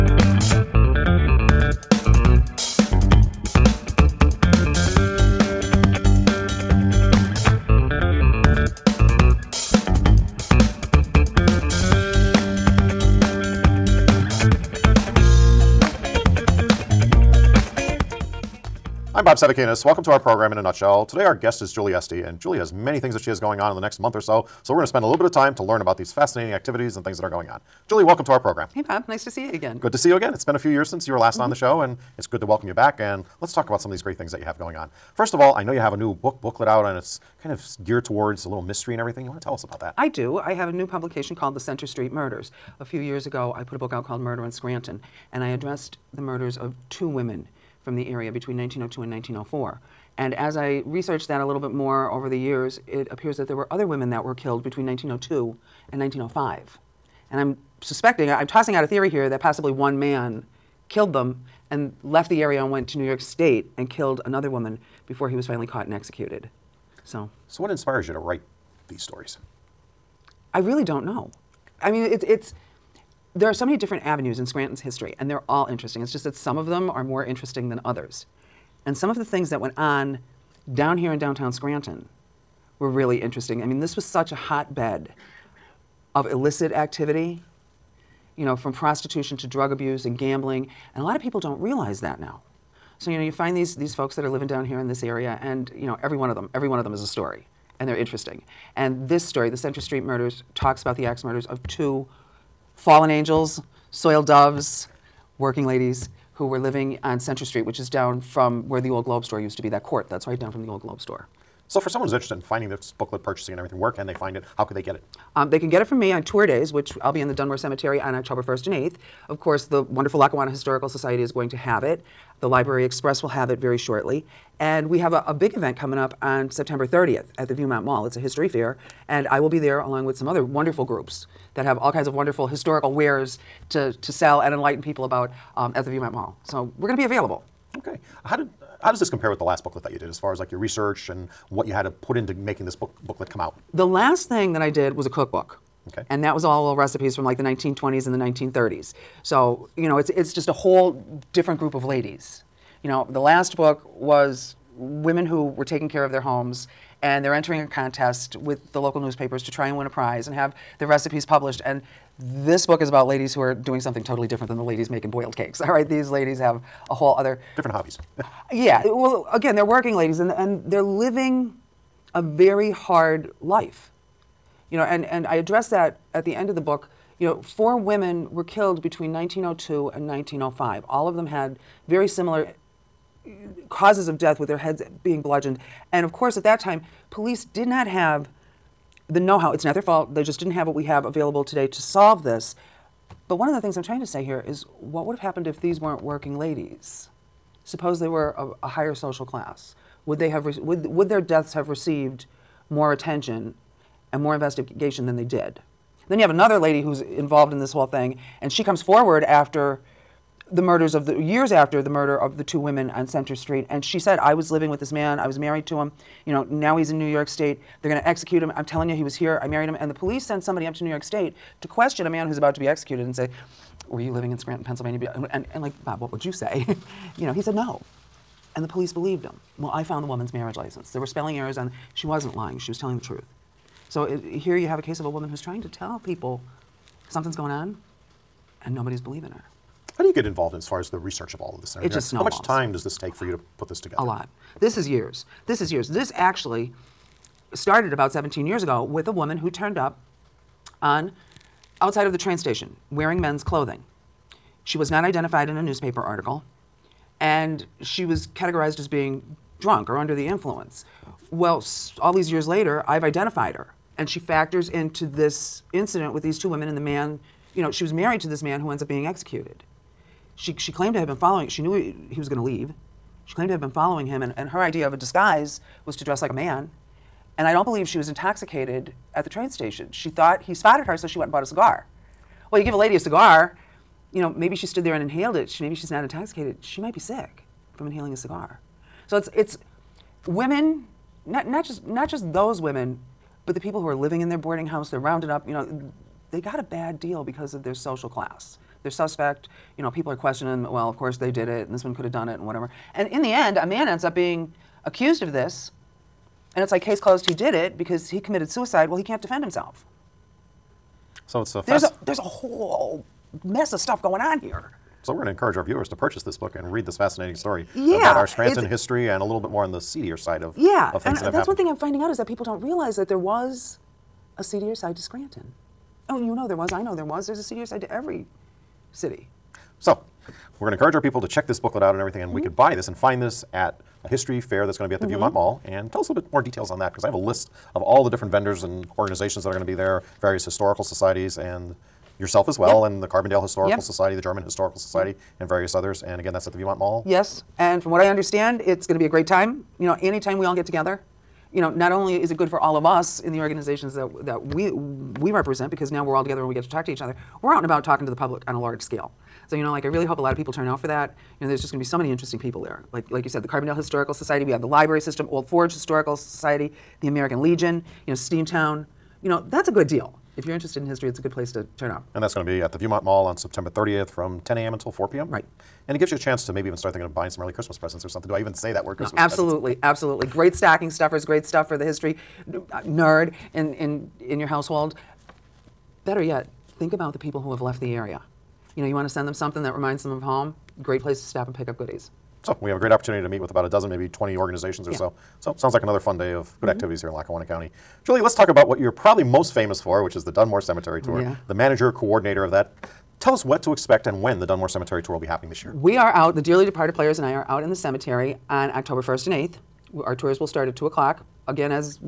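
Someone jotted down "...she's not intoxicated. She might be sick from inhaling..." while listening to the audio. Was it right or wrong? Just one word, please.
right.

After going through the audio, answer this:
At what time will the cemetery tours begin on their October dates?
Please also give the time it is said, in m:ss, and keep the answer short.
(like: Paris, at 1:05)
2 o'clock, at 6:50.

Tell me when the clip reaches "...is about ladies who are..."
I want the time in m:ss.
2:42.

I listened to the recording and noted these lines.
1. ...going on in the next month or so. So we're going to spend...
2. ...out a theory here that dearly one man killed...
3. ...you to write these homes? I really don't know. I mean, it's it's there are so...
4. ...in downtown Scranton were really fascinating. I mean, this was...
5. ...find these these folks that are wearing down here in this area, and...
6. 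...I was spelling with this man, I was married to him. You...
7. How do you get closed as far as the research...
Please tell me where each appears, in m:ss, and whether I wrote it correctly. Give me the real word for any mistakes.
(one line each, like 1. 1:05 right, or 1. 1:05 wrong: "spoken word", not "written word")
1. 0:23 right
2. 0:58 wrong: "possibly", not "dearly"
3. 1:08 wrong: "stories", not "homes"
4. 1:21 wrong: "interesting", not "fascinating"
5. 1:33 wrong: "living", not "wearing"
6. 3:34 wrong: "living", not "spelling"
7. 3:59 wrong: "involved", not "closed".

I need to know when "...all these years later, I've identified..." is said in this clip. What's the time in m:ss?
4:22.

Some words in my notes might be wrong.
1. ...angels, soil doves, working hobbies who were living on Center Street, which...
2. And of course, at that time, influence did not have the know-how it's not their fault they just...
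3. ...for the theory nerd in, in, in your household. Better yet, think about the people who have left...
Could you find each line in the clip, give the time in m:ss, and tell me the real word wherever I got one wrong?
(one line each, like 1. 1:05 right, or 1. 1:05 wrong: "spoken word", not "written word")
1. 1:43 wrong: "ladies", not "hobbies"
2. 3:05 wrong: "police", not "influence"
3. 6:21 wrong: "history", not "theory".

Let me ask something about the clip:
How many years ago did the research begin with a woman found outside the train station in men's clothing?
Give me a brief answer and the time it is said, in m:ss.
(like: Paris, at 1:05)
17, at 4:08.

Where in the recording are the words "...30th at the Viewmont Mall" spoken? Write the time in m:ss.
2:06.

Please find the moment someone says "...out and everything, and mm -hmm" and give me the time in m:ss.
5:31.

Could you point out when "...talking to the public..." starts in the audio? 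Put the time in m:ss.
5:57.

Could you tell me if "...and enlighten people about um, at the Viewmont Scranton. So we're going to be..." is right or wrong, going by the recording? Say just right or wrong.
wrong.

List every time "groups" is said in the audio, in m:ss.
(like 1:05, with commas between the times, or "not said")
2:10, 2:31.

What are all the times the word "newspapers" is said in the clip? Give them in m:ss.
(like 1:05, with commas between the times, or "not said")
2:38, 4:15.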